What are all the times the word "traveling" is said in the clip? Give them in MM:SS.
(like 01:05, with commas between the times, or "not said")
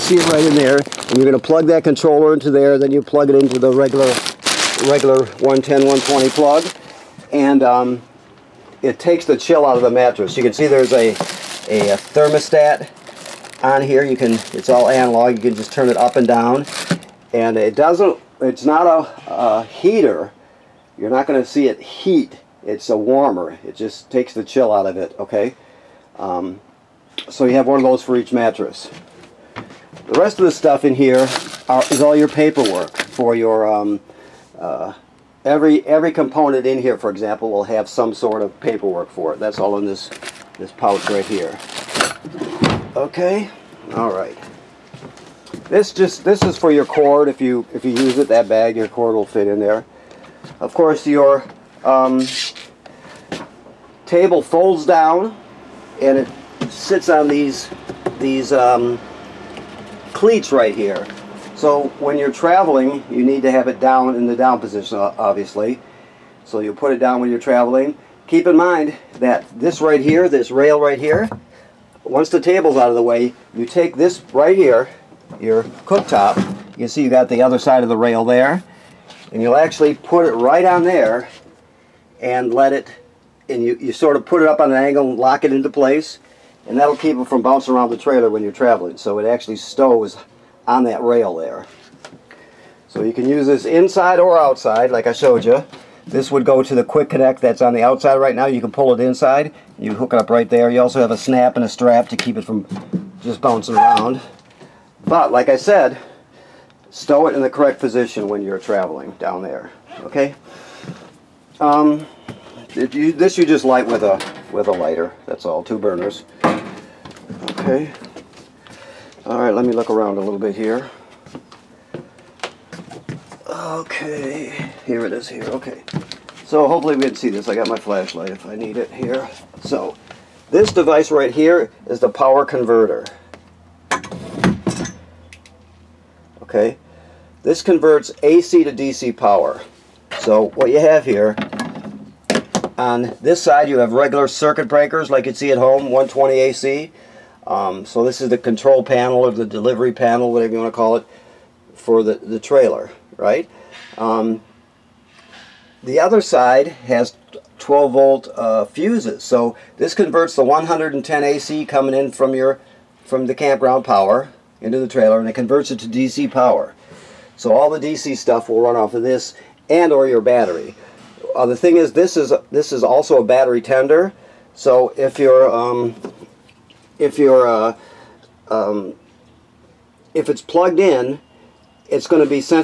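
01:02, 01:07, 01:28, 01:48.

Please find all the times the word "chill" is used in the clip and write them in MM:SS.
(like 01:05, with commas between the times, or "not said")
00:09, 00:24.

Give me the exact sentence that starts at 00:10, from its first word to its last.
You can see there's a, a, a thermostat on here.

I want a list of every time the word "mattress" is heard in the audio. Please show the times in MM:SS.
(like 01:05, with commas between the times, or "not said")
00:09, 00:28.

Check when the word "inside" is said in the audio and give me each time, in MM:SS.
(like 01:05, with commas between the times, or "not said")
01:33, 01:39.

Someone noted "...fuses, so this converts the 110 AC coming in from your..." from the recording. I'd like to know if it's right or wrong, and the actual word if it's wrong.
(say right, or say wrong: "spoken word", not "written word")
right.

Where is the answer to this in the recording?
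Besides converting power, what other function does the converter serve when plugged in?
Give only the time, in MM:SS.
02:53.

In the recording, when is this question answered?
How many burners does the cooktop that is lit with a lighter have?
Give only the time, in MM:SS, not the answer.
01:55.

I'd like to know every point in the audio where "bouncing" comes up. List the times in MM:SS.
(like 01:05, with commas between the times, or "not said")
01:27, 01:43.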